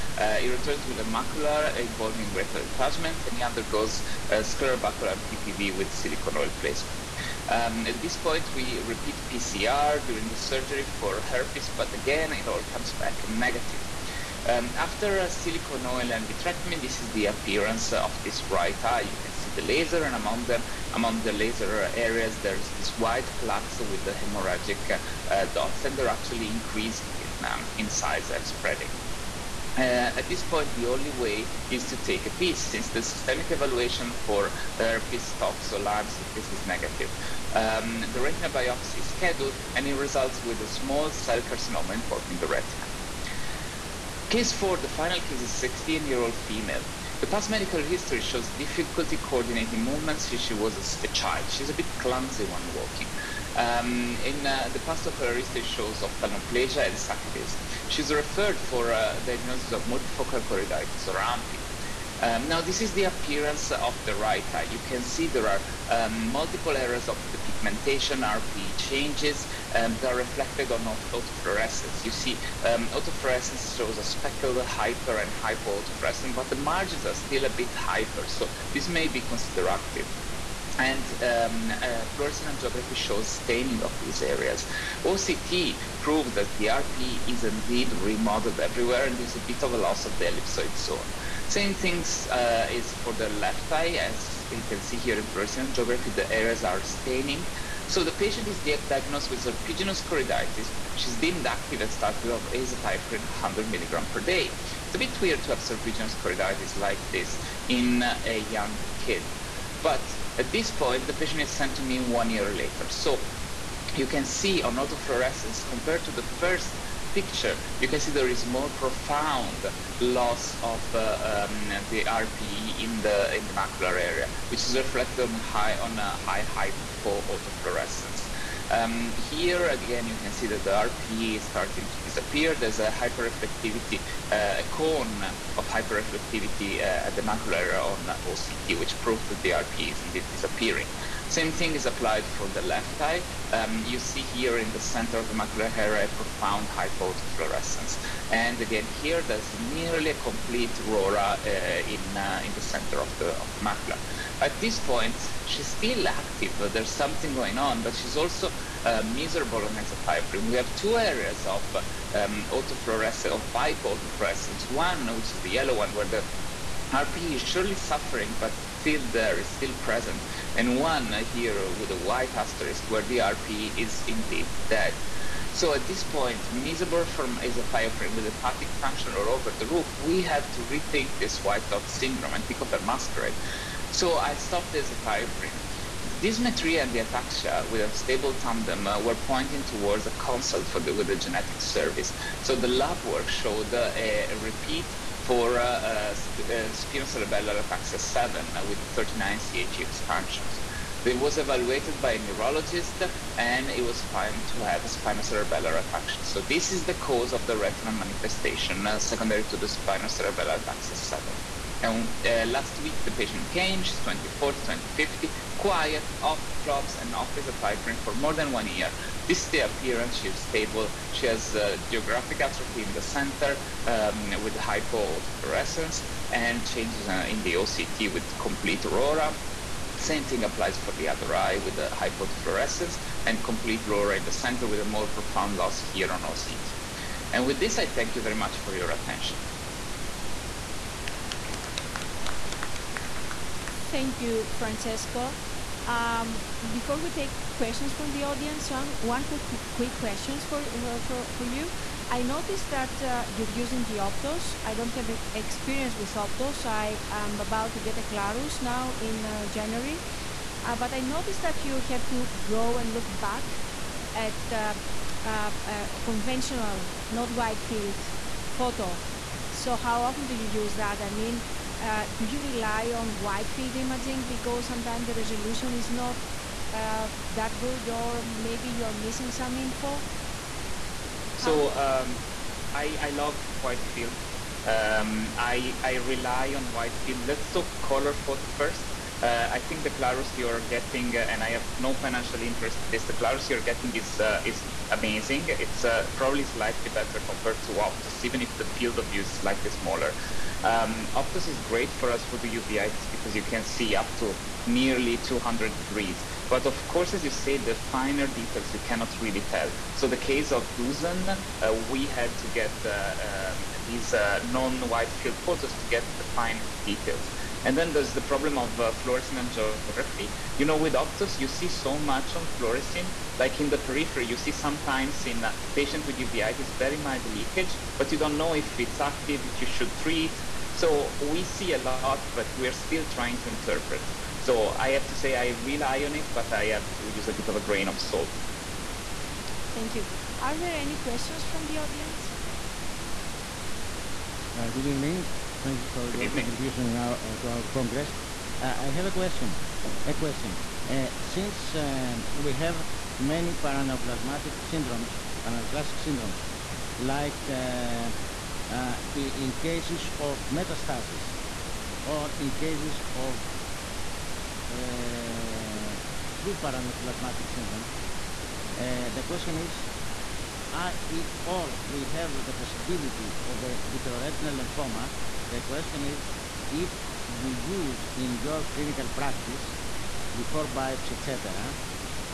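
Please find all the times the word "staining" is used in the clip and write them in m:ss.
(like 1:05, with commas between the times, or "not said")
1:23, 1:36.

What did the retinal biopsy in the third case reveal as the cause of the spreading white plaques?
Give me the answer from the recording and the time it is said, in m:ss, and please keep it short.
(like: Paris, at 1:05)
small cell carcinoma, at 0:40.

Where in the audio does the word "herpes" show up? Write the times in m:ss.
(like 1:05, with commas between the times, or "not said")
0:11, 0:34.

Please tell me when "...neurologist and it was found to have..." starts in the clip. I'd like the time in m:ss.
3:22.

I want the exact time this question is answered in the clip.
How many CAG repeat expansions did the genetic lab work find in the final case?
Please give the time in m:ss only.
3:18.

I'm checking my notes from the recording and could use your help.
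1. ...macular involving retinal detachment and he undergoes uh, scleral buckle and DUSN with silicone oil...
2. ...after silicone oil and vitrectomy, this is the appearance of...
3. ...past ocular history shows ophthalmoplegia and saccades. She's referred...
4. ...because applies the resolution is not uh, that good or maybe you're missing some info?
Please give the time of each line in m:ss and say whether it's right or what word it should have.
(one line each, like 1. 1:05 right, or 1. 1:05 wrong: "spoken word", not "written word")
1. 0:01 wrong: "PPV", not "DUSN"
2. 0:14 right
3. 0:54 right
4. 4:34 wrong: "sometimes", not "applies".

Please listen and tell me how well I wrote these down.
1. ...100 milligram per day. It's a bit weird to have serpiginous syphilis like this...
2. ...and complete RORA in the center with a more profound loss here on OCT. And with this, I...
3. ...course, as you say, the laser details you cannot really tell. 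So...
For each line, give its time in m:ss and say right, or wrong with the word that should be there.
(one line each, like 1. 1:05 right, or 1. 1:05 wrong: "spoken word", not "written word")
1. 1:43 wrong: "choroiditis", not "syphilis"
2. 3:53 right
3. 5:06 wrong: "finer", not "laser".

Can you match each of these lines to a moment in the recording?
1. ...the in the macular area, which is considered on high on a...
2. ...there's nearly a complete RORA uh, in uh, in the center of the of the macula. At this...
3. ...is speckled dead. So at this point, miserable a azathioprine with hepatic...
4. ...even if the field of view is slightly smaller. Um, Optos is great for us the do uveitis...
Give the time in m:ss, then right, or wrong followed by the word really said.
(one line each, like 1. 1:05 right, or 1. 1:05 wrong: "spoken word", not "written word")
1. 2:03 wrong: "reflected", not "considered"
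2. 2:29 right
3. 2:53 wrong: "indeed", not "speckled"
4. 4:58 right.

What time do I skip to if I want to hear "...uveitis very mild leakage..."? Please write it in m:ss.
5:26.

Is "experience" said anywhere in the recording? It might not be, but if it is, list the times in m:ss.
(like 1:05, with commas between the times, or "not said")
4:15.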